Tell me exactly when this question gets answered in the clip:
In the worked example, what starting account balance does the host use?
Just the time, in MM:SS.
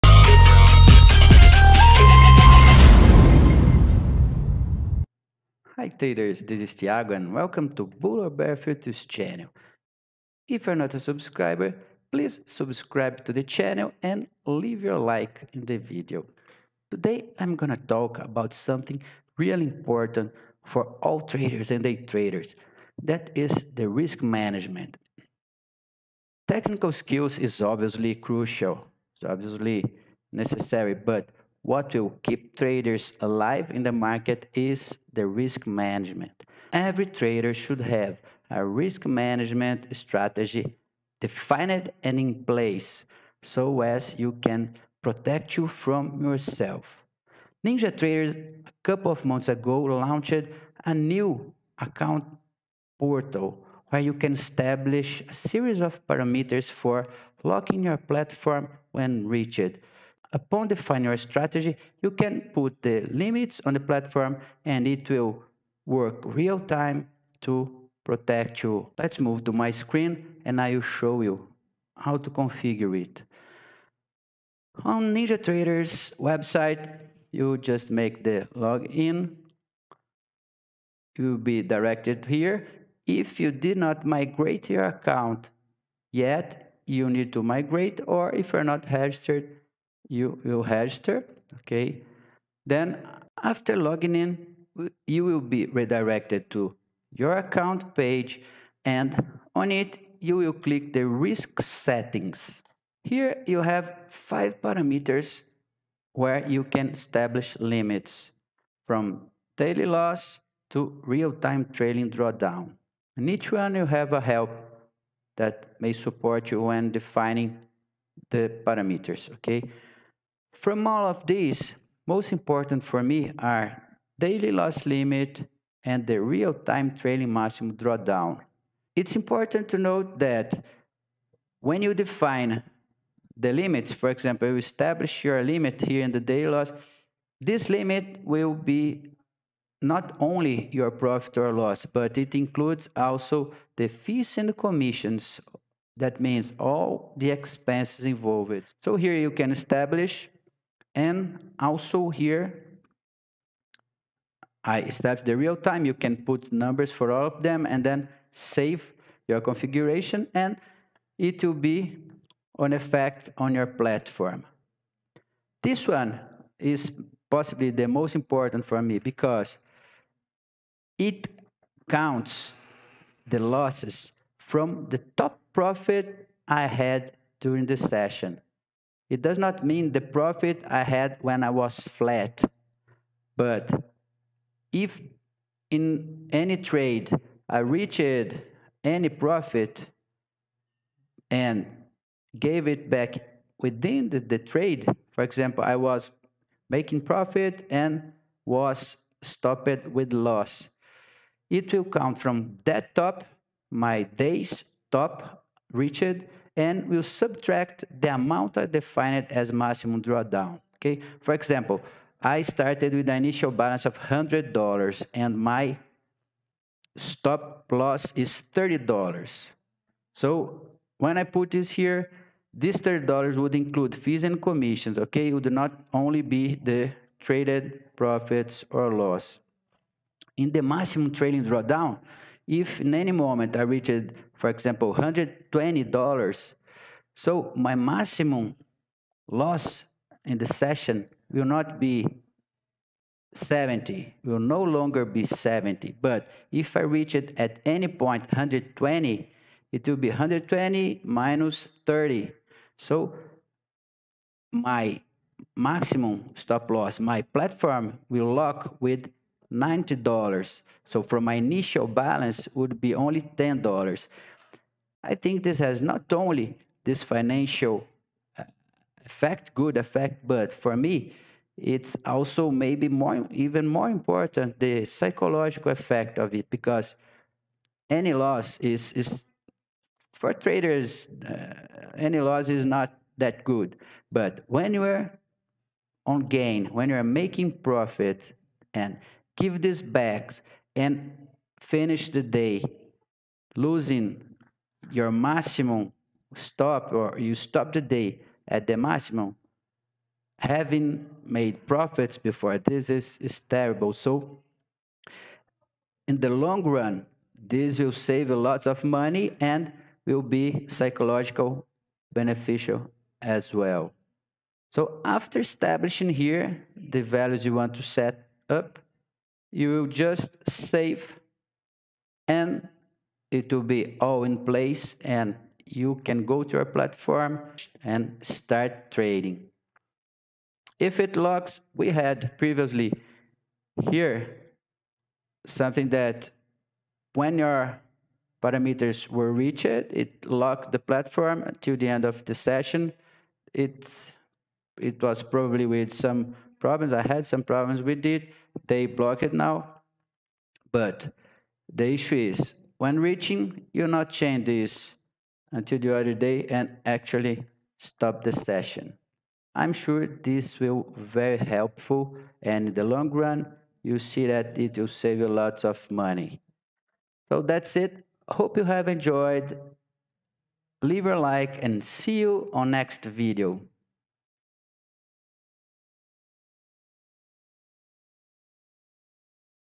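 03:33.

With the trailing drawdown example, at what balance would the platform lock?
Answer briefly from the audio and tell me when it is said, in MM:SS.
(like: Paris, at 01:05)
$90, at 04:19.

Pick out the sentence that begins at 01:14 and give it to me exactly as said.
On NinjaTrader's website, you just make the login.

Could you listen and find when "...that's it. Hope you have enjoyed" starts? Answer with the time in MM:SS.
06:07.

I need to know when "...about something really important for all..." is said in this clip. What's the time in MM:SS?
00:18.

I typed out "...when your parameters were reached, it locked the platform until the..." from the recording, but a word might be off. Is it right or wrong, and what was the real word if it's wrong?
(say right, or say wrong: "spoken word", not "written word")
right.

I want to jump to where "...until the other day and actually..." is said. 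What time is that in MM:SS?
05:55.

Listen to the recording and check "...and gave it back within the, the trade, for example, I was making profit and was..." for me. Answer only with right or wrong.
right.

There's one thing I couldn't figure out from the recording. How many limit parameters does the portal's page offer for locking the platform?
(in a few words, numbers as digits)
5.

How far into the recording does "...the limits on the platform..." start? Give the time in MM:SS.
01:02.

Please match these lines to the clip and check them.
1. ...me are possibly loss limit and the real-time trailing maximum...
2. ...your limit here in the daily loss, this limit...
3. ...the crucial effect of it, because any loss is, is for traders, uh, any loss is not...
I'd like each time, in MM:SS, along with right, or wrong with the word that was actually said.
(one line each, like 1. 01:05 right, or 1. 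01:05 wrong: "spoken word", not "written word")
1. 02:03 wrong: "daily", not "possibly"
2. 02:15 right
3. 04:34 wrong: "psychological", not "crucial".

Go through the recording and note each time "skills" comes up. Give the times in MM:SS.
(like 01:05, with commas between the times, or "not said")
00:26.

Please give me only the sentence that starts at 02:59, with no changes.
It does not mean the profit I had when I was flat.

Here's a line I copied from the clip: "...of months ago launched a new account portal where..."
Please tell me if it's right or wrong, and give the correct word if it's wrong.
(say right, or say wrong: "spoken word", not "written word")
right.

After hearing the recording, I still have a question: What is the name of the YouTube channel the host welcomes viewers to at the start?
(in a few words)
Bull or Bear Futures.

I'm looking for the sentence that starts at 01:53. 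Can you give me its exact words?
In each one you have a help that may support you when defining the parameters, okay?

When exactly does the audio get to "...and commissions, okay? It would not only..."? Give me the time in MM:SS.
03:44.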